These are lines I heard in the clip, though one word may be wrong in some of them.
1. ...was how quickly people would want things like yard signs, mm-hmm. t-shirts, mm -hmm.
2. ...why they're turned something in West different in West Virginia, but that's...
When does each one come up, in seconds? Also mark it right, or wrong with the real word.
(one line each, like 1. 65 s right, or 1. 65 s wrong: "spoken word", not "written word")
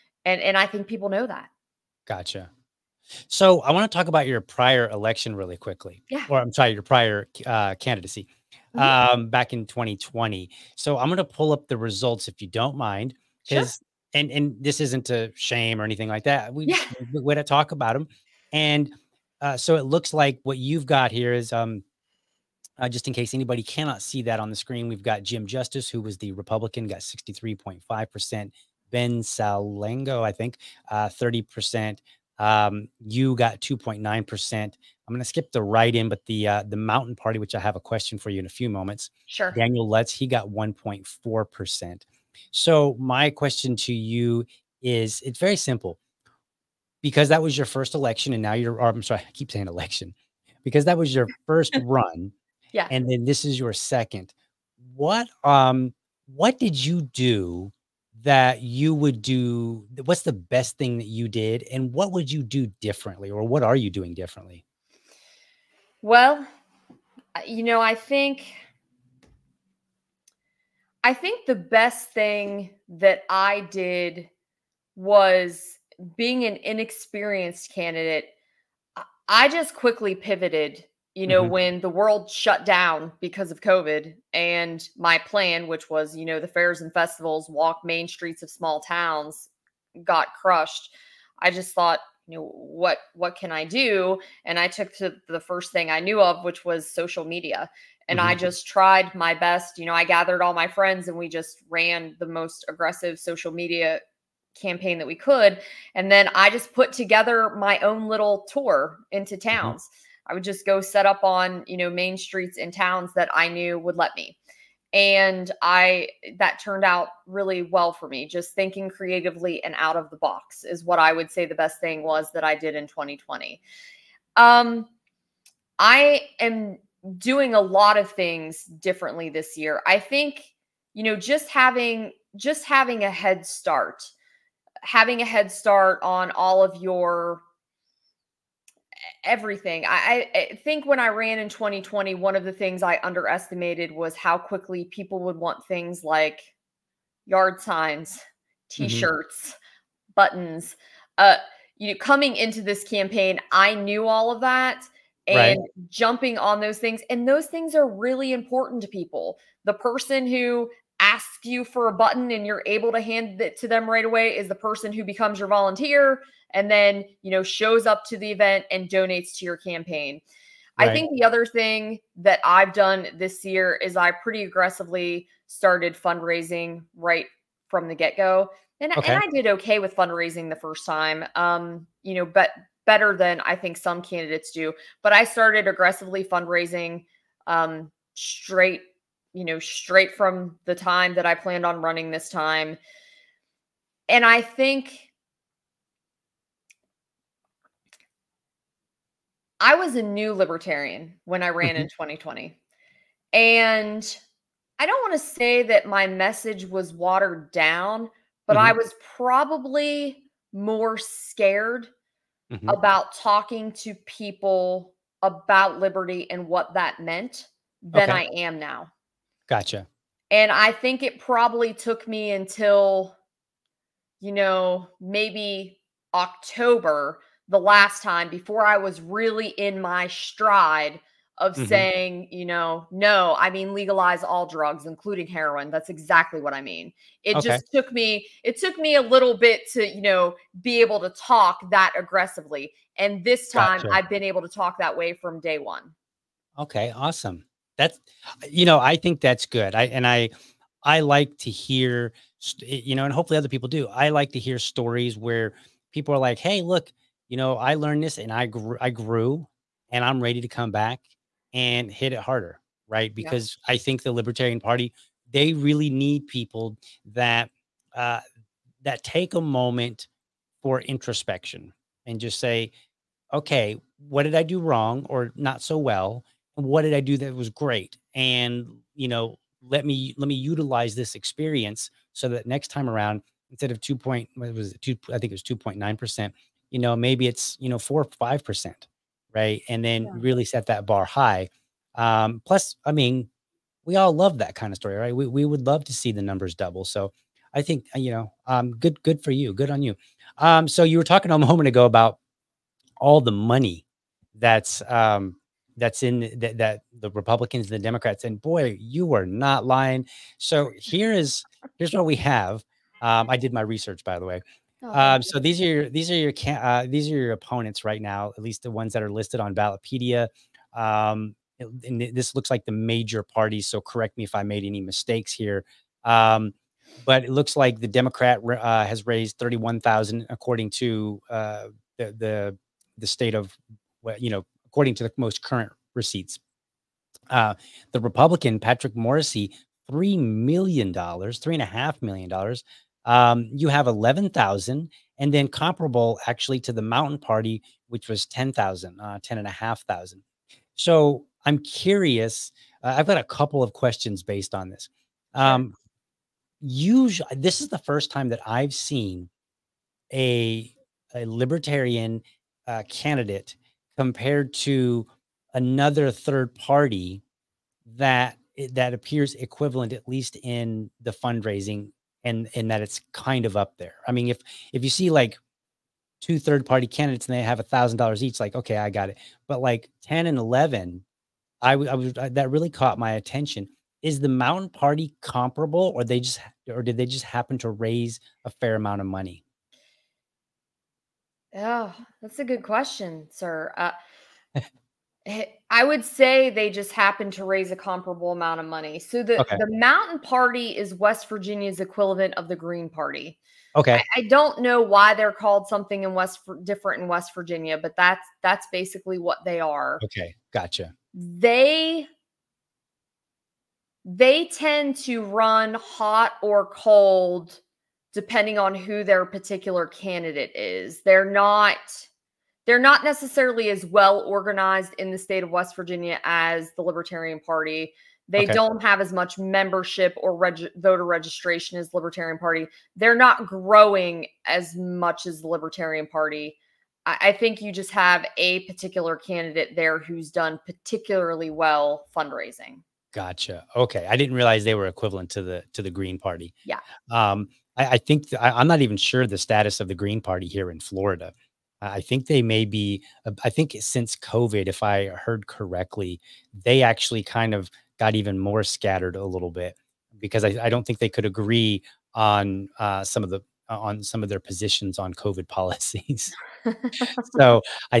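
1. 143 s right
2. 404 s wrong: "called", not "turned".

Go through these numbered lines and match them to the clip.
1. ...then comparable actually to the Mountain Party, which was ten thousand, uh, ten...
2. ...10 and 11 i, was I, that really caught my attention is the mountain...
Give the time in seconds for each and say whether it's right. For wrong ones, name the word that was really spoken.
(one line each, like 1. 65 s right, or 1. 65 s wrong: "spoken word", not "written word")
1. 345 s right
2. 380 s right.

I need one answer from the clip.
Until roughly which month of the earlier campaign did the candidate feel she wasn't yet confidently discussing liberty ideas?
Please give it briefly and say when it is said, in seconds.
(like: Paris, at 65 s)
October, at 226 s.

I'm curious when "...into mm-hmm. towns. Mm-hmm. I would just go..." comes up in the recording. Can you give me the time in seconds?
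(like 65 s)
109 s.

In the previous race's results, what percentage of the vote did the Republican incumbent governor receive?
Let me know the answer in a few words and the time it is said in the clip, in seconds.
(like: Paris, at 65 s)
63.5%, at 26 s.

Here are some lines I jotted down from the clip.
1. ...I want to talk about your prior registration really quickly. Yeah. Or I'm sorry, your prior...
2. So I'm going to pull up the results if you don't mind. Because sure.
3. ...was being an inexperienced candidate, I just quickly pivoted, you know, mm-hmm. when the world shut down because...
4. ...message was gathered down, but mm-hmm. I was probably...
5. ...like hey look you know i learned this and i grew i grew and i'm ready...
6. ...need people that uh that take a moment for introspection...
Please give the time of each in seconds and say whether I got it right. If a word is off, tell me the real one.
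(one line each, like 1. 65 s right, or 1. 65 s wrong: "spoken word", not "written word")
1. 3 s wrong: "election", not "registration"
2. 10 s right
3. 74 s right
4. 206 s wrong: "watered", not "gathered"
5. 256 s right
6. 265 s right.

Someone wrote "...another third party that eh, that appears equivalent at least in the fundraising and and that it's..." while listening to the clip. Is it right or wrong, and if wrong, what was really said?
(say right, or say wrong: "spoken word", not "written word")
right.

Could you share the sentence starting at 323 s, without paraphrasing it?
So correct me if I made any mistakes here.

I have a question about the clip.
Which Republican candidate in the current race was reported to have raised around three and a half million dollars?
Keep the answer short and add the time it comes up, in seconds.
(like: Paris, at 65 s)
Patrick Morrisey, at 338 s.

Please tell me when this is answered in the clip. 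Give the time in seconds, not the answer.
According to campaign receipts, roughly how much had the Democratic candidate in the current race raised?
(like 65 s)
329 s.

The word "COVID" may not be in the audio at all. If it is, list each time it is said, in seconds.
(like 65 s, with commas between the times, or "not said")
83 s, 454 s, 465 s.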